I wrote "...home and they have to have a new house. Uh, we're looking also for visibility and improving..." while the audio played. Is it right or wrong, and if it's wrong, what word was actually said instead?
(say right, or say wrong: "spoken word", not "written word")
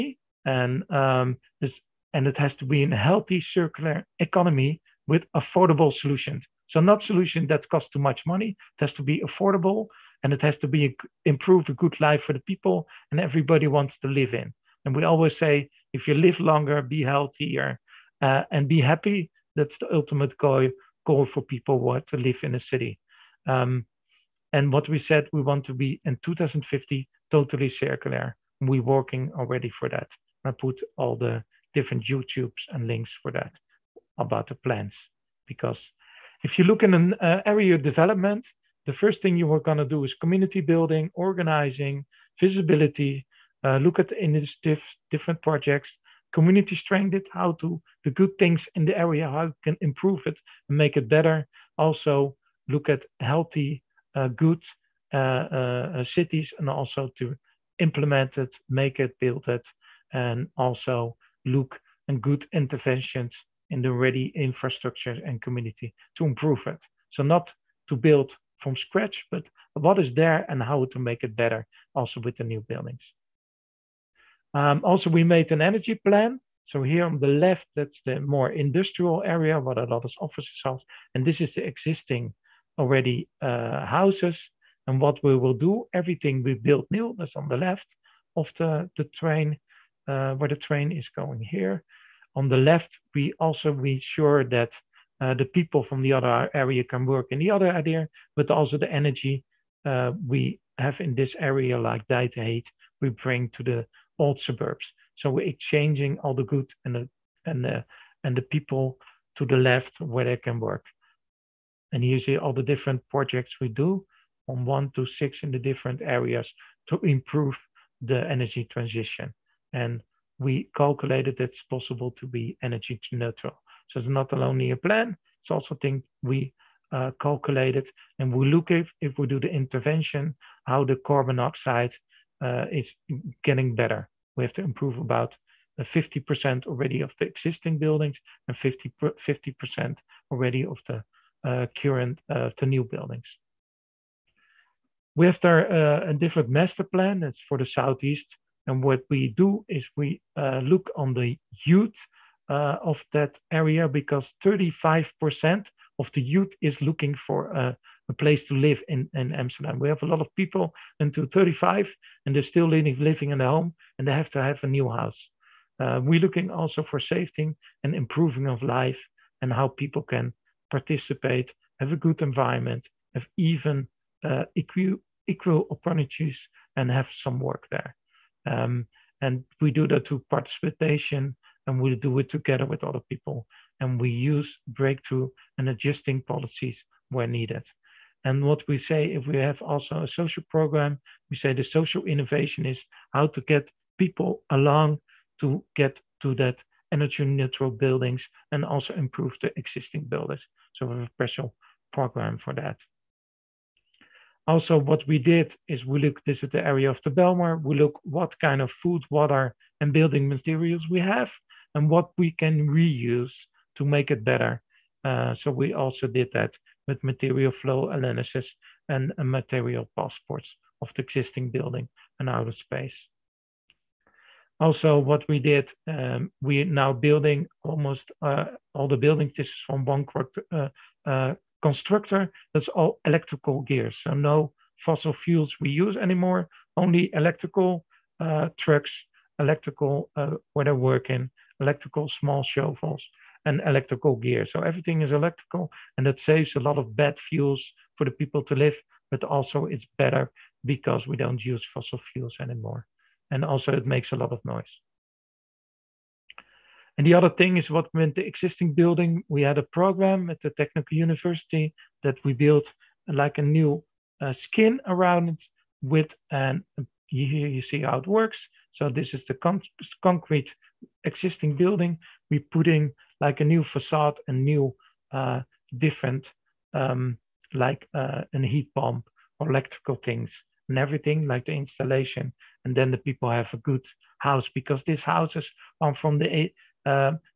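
wrong: "safety", not "visibility".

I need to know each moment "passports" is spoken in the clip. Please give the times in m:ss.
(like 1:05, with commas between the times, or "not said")
3:39.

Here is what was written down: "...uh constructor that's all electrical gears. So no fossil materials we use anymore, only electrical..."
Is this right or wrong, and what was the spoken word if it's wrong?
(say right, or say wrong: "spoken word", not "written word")
wrong: "fuels", not "materials".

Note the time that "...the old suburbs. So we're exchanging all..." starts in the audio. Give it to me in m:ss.
1:43.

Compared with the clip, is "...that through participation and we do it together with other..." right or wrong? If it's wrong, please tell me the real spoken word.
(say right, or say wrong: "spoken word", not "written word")
right.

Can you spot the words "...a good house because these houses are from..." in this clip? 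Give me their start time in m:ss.
4:43.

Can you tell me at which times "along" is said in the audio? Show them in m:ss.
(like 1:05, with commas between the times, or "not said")
3:14.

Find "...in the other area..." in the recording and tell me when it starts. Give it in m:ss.
1:37.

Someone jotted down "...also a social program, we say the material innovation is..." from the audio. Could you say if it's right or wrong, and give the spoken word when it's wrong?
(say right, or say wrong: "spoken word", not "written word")
wrong: "social", not "material".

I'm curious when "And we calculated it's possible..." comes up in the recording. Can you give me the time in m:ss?
1:59.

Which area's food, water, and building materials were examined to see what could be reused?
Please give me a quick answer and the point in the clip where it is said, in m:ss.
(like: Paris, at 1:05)
Bijlmer, at 3:27.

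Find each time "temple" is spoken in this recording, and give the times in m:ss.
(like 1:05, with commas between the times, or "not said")
not said.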